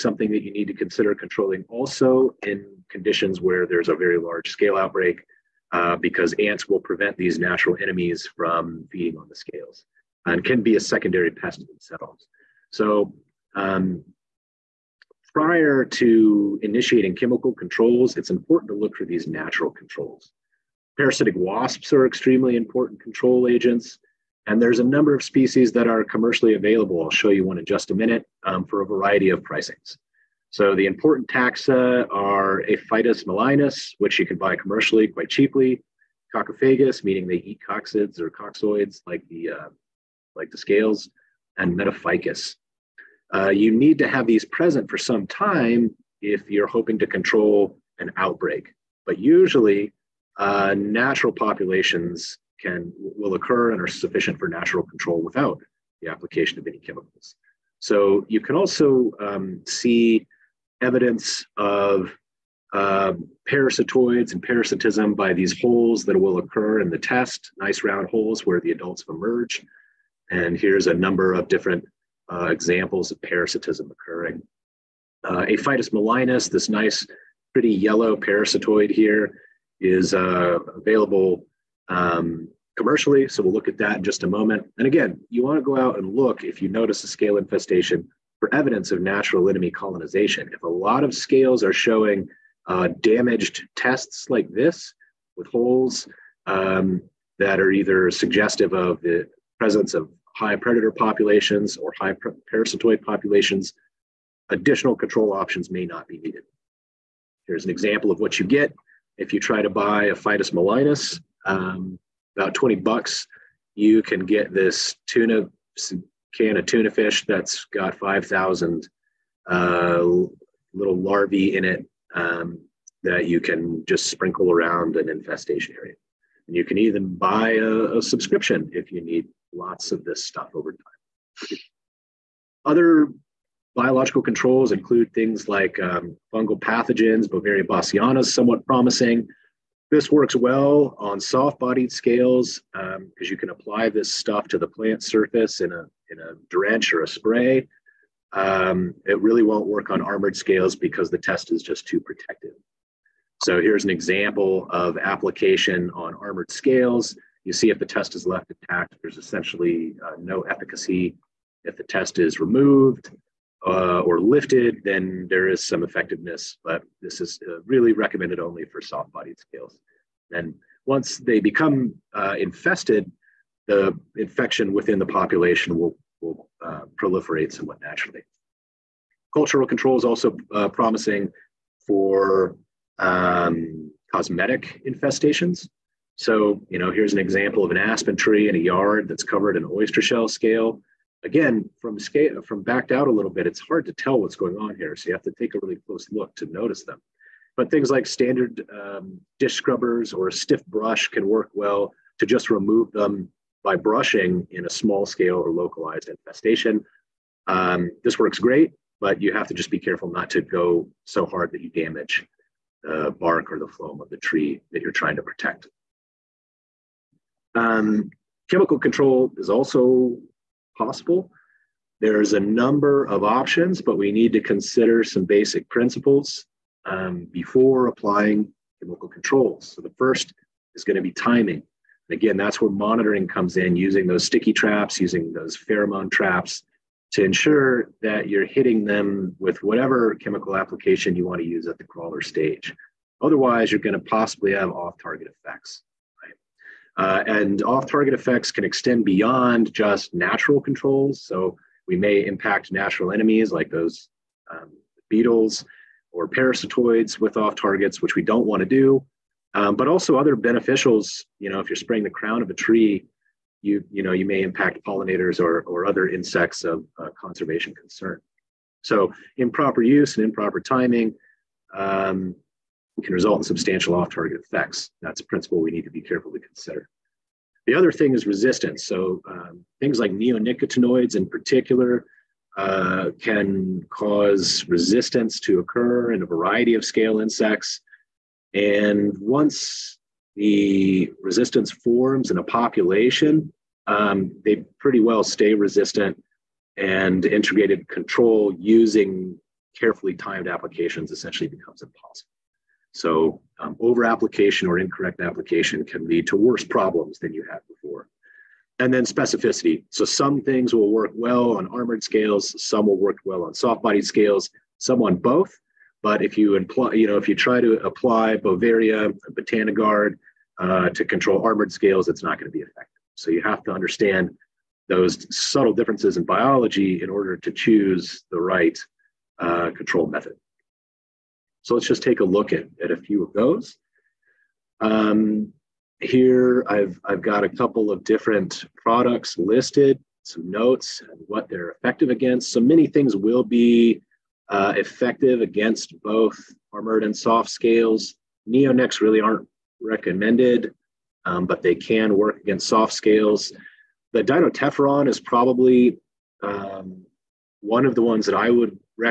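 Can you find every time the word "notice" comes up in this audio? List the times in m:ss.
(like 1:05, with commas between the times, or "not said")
1:26, 3:16.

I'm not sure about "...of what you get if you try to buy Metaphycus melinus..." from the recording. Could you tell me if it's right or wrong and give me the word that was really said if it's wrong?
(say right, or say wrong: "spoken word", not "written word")
wrong: "Aphytis", not "Metaphycus".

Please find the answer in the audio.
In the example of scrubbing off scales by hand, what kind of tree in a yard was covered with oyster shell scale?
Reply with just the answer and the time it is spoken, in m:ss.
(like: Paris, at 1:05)
Aspen, at 3:07.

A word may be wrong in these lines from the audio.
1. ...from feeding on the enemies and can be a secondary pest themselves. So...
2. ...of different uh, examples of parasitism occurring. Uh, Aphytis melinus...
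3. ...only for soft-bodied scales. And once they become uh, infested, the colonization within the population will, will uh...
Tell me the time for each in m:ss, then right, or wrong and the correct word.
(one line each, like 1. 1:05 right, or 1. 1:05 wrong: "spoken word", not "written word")
1. 0:08 wrong: "scales", not "enemies"
2. 1:11 right
3. 2:48 wrong: "infection", not "colonization".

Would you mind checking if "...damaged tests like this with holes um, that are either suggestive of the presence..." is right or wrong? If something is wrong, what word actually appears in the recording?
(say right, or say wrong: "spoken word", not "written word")
right.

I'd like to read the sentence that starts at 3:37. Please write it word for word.
Um, chemical control is also possible.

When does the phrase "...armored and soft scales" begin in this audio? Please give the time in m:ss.
5:46.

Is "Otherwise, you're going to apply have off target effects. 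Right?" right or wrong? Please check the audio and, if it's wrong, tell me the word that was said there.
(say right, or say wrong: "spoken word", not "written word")
wrong: "possibly", not "apply".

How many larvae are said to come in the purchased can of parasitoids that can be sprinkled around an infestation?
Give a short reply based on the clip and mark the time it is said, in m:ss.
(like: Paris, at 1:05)
5,000, at 1:57.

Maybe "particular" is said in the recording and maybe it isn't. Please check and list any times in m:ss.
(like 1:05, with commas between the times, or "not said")
4:41.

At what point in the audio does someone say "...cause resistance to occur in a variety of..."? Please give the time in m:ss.
4:43.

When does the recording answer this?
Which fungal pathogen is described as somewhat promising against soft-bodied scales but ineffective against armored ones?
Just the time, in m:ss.
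2:17.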